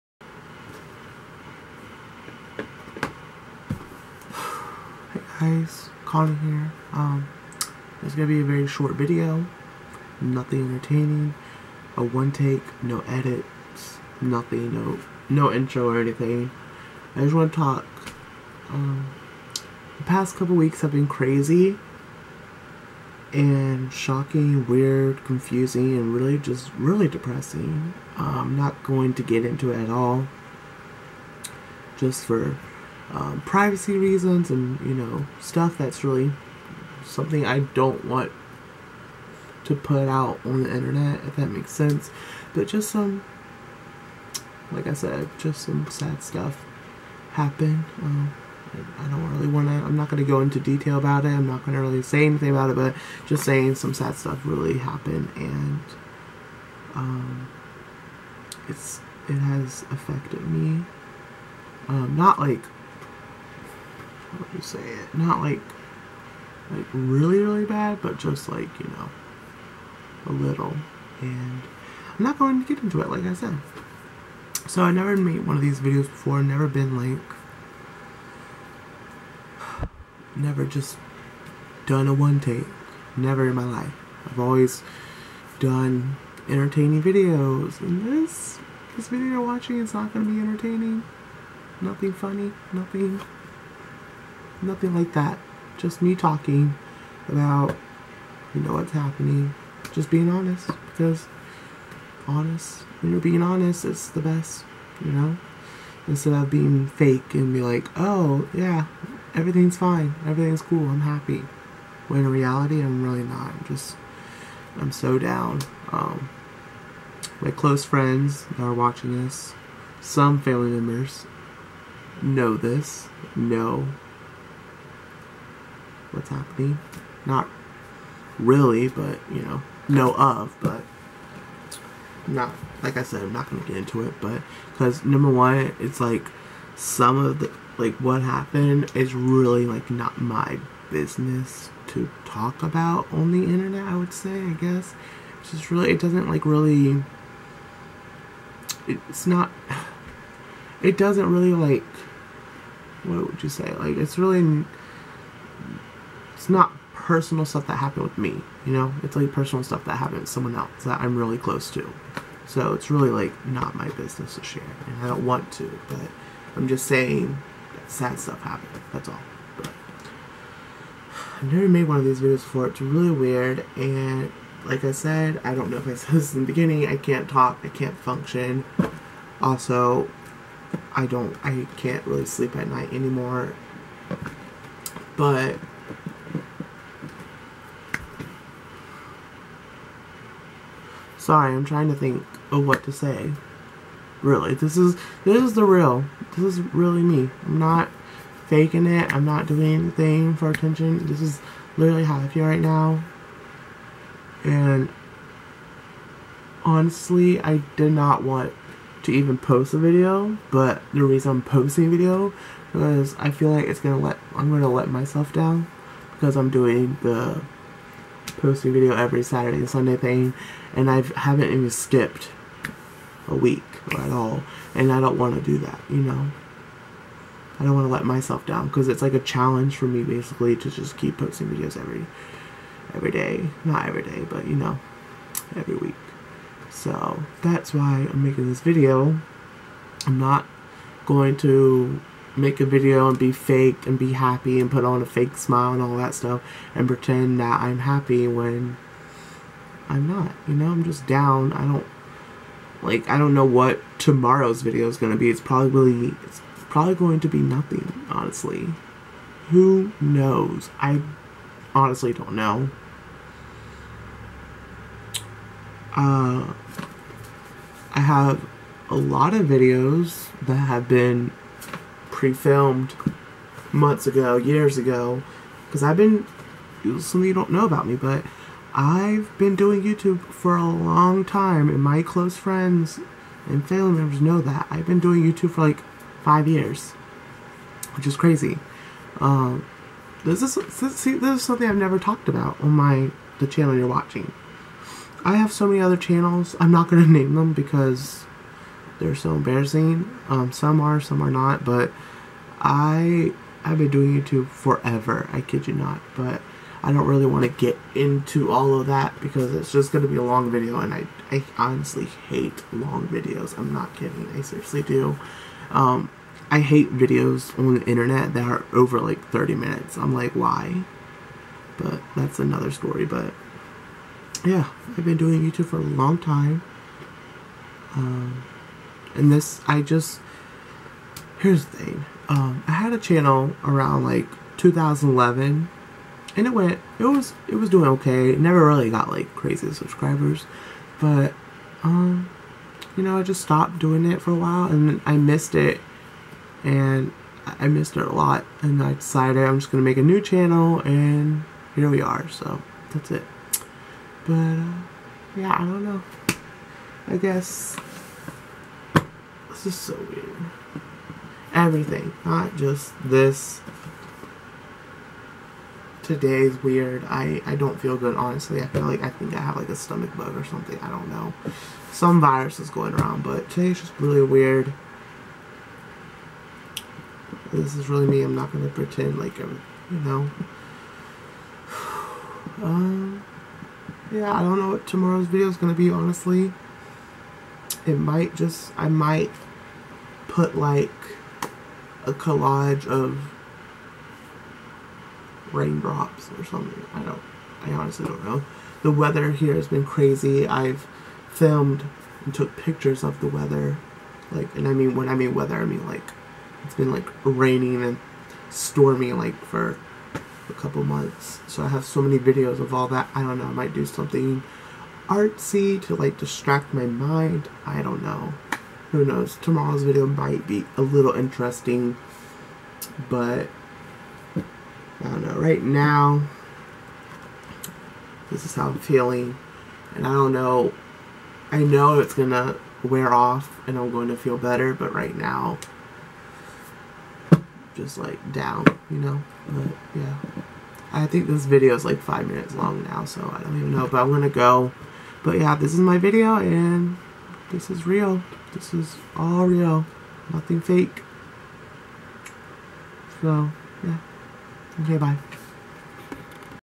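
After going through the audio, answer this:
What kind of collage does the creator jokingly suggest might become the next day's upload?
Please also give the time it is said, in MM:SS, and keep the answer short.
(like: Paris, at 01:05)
Raindrops, at 06:35.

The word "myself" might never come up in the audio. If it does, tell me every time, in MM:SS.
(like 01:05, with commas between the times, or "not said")
03:34, 03:48.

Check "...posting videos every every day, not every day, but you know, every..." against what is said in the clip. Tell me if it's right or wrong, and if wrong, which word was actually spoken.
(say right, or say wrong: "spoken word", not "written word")
right.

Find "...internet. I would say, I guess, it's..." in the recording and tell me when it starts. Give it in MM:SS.
02:23.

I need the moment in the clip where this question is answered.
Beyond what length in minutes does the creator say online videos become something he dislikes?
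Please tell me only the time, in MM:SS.
05:19.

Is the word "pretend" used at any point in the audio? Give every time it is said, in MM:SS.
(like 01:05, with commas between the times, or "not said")
04:06, 06:18.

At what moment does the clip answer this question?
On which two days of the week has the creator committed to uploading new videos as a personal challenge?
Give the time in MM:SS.
03:39.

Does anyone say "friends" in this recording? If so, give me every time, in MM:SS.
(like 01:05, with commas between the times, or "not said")
01:57, 04:42.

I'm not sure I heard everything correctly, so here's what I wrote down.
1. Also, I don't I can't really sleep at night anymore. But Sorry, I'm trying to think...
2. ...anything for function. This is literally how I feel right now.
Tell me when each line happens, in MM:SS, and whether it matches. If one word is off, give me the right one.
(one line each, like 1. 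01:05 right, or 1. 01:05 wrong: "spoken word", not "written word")
1. 02:59 right
2. 03:19 wrong: "attention", not "function".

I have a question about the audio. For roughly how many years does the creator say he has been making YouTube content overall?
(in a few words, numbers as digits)
5.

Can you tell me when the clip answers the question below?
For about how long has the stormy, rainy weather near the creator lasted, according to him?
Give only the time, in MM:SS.
06:50.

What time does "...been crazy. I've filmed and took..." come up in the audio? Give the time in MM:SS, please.
06:39.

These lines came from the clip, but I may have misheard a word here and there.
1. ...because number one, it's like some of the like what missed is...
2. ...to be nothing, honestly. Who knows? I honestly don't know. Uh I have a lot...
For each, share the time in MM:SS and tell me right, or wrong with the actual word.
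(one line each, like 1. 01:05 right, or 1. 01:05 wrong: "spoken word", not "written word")
1. 02:14 wrong: "happened", not "missed"
2. 04:17 right.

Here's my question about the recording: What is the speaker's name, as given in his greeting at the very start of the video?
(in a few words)
Connor.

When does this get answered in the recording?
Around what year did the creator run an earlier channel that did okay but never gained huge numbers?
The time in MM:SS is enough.
05:34.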